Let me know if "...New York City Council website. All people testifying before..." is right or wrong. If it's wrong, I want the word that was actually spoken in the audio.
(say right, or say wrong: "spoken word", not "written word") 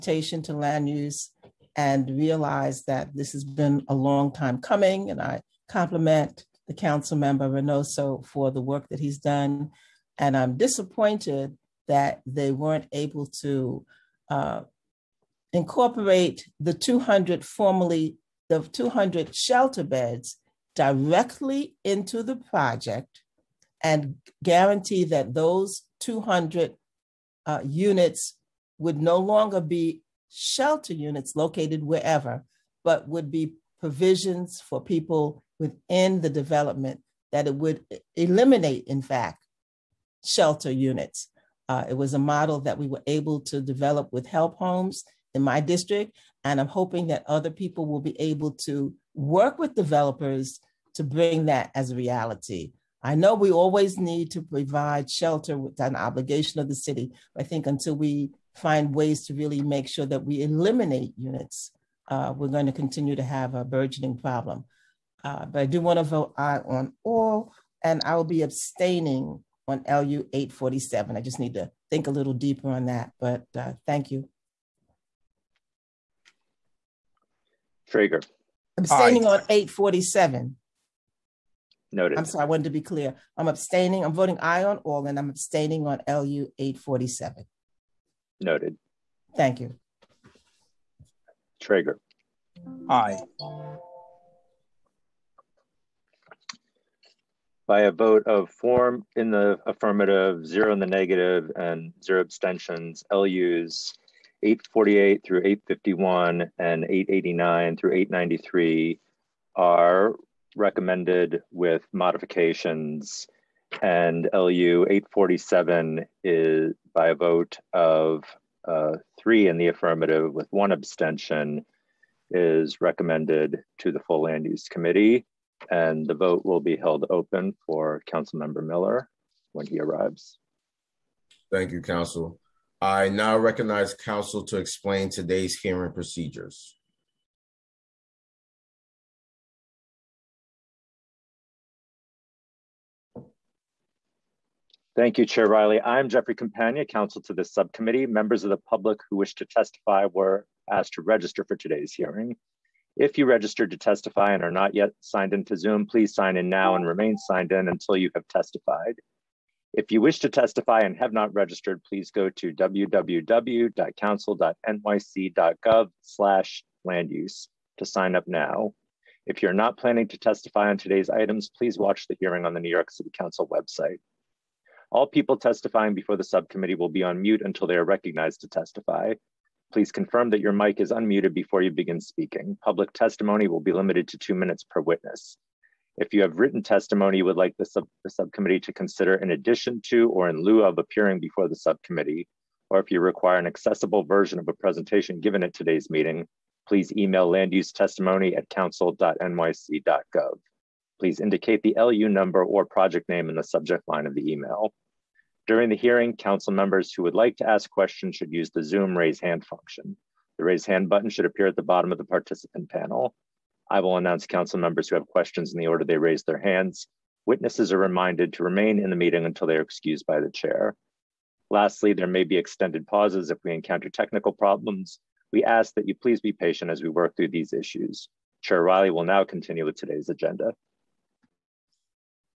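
right.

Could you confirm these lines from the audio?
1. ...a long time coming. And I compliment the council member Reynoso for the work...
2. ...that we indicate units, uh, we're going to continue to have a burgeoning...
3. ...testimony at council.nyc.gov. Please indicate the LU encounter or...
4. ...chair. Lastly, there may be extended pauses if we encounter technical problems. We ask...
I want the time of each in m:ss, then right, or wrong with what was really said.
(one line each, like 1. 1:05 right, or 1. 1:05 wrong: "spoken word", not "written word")
1. 0:03 right
2. 1:00 wrong: "eliminate", not "indicate"
3. 3:17 wrong: "number", not "encounter"
4. 3:40 right.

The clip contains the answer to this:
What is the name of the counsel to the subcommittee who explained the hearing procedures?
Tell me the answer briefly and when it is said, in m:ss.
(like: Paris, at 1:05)
Jeffrey Campagna, at 2:26.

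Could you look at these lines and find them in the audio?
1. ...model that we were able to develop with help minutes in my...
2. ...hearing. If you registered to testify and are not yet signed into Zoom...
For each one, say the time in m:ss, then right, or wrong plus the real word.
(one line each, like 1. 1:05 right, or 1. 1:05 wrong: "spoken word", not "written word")
1. 0:42 wrong: "homes", not "minutes"
2. 2:31 right.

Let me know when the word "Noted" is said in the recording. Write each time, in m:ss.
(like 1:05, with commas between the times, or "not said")
1:21, 1:28.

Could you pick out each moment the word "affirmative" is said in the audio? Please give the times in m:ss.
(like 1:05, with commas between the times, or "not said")
1:39, 1:59.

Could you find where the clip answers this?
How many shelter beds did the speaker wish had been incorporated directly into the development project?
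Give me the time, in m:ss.
0:18.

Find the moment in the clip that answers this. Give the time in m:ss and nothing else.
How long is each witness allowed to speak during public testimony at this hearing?
3:04.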